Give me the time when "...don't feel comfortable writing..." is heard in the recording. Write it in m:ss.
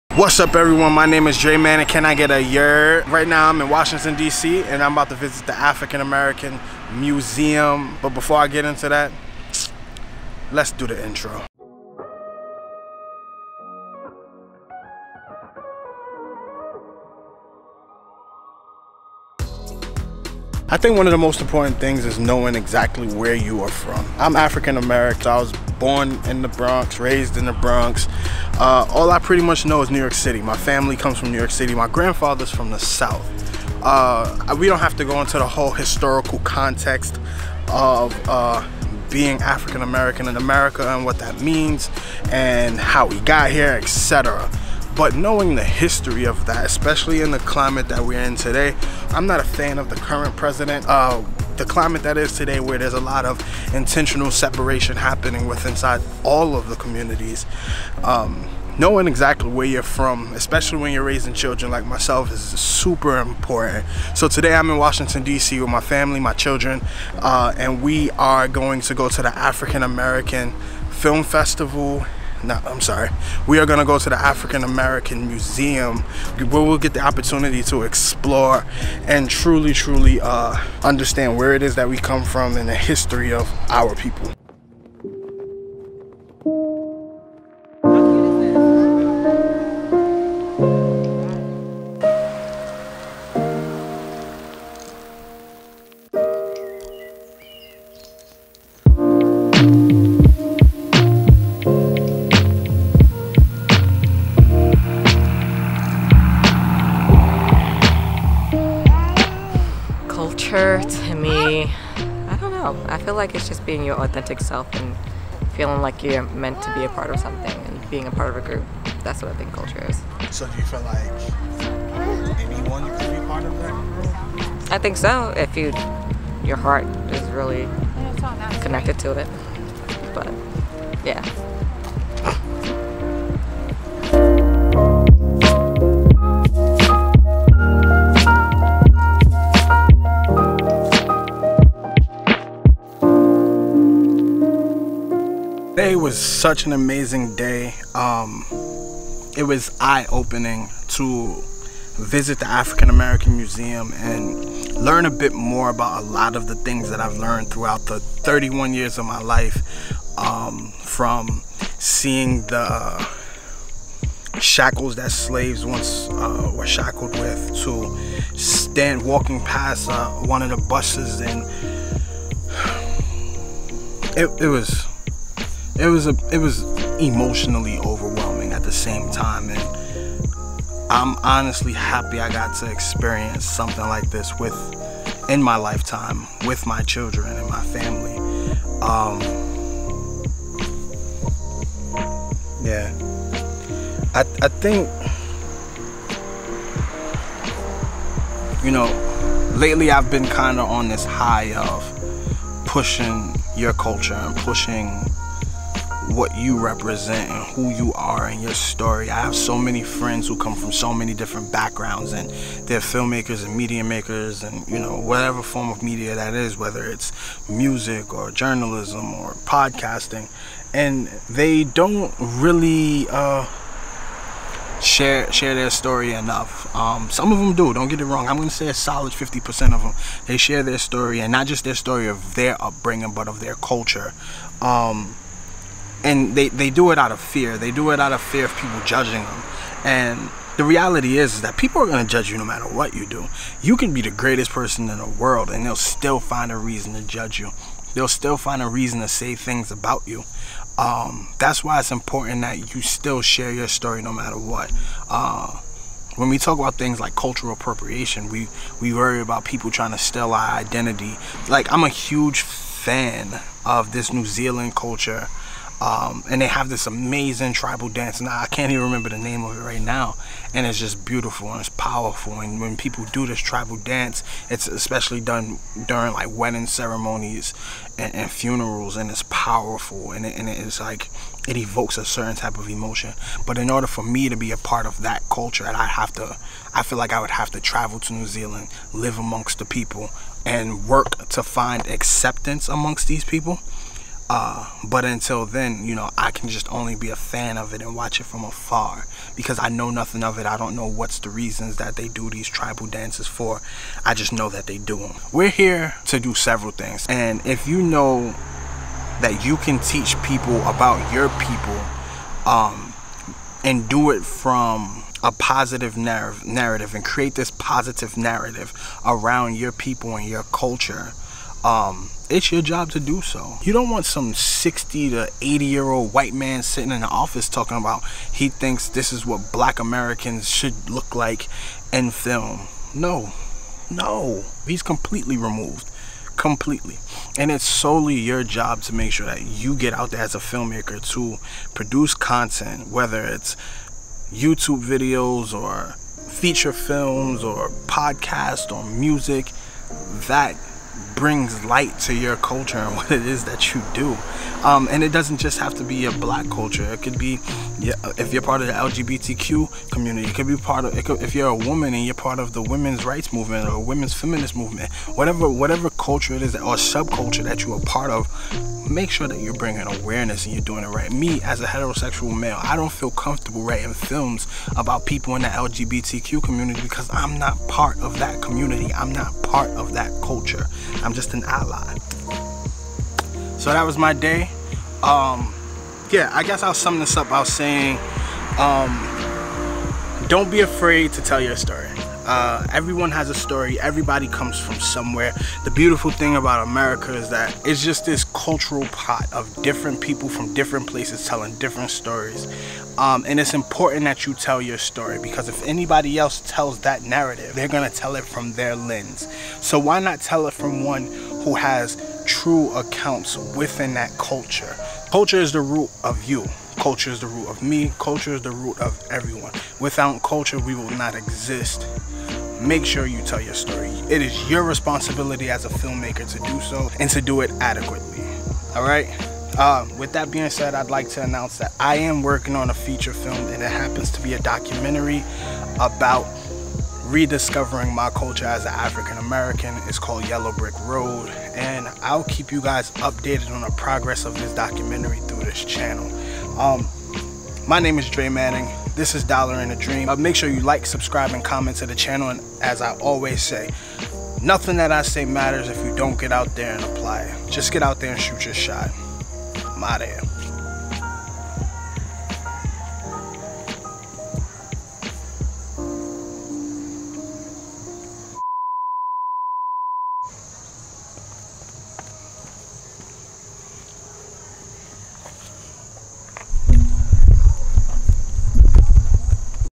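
6:12.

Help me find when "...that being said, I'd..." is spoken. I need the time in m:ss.
7:10.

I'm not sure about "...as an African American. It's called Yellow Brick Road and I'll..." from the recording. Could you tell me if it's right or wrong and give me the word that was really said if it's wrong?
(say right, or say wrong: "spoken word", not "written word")
right.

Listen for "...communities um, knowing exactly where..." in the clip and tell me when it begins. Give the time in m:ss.
0:56.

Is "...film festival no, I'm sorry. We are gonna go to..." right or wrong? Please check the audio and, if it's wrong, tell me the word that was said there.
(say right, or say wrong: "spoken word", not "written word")
right.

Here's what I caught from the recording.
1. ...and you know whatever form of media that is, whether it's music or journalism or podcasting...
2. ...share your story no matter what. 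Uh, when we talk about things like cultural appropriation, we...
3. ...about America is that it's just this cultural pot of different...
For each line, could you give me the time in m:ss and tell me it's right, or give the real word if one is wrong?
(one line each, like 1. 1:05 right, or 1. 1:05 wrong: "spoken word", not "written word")
1. 3:34 right
2. 4:13 right
3. 6:36 right.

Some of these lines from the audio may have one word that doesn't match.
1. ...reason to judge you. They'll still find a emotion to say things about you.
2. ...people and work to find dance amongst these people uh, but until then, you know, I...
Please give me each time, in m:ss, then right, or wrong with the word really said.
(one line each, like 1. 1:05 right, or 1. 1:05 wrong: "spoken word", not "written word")
1. 4:06 wrong: "reason", not "emotion"
2. 4:49 wrong: "acceptance", not "dance".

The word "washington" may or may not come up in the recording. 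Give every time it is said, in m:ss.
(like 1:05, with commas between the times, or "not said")
0:03, 1:04.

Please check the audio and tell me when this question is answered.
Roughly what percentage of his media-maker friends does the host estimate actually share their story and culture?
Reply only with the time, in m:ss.
3:49.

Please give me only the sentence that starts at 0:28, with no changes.
Uh, all I pretty much know is New York City.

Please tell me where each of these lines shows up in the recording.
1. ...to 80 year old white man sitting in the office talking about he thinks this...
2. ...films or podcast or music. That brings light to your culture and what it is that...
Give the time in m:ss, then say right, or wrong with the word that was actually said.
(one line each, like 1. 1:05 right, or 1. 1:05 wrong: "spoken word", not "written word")
1. 5:25 right
2. 5:46 right.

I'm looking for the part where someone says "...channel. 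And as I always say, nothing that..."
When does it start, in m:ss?
7:31.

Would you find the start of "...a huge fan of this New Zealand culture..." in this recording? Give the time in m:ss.
4:21.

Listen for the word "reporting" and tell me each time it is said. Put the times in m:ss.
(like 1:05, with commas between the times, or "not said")
not said.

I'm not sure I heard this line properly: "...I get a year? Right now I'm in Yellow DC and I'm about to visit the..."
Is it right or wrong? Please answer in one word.
wrong.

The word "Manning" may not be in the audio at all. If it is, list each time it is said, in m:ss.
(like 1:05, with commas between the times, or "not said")
0:01, 7:28.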